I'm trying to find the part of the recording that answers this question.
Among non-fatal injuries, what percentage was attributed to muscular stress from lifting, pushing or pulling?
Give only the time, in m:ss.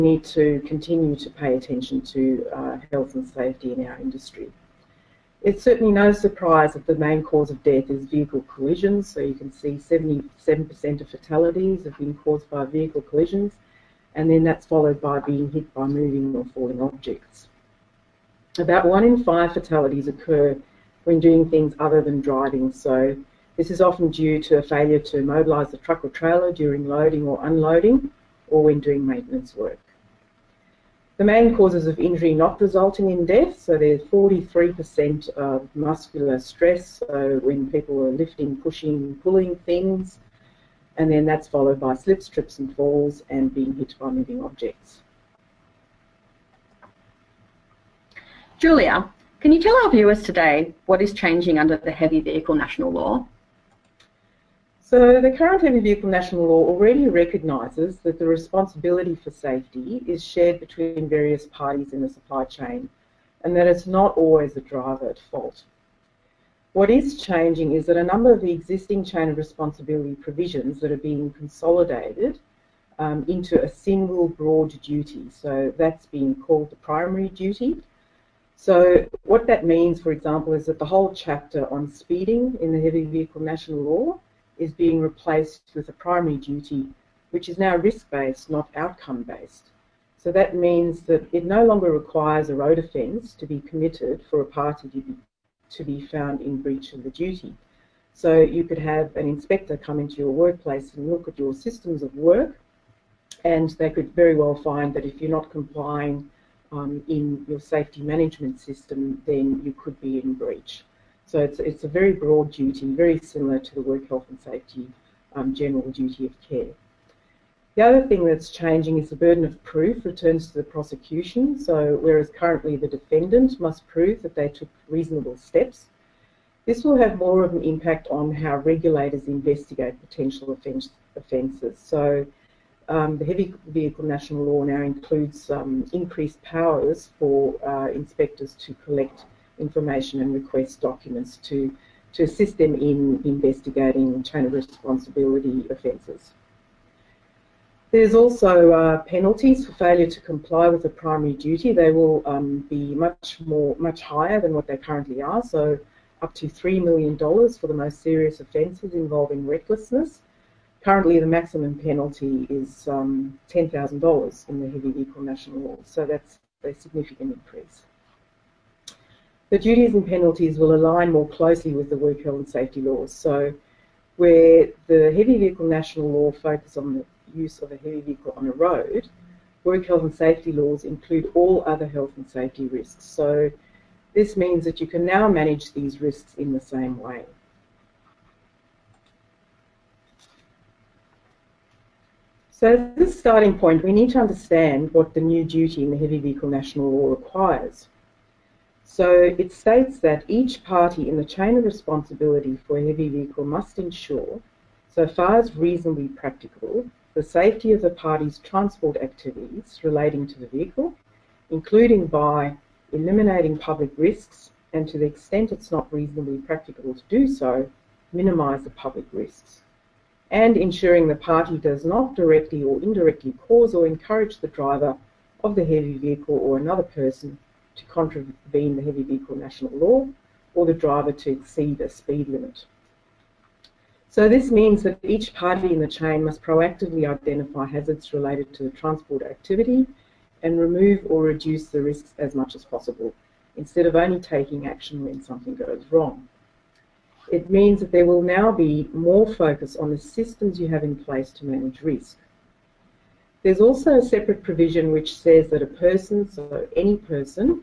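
0:34.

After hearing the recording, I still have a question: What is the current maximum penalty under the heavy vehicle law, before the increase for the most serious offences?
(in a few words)
$10,000.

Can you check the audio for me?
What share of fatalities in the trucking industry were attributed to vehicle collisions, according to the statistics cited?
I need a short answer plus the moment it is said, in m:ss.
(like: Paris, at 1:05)
77%, at 0:09.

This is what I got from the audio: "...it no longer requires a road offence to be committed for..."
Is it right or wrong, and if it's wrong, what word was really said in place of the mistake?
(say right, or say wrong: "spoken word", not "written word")
right.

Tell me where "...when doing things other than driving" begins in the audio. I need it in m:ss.
0:21.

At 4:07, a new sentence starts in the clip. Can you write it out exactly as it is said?
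It means that there will now be more focus on the systems you have in place to manage risk.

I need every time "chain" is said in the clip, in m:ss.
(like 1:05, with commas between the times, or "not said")
1:02, 1:09, 2:24, 3:21, 3:55.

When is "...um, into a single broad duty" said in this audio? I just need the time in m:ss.
1:12.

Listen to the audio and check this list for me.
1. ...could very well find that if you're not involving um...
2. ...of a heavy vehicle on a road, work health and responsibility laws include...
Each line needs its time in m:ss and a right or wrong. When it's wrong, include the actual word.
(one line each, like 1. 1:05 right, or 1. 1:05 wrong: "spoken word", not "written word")
1. 1:43 wrong: "complying", not "involving"
2. 2:57 wrong: "safety", not "responsibility".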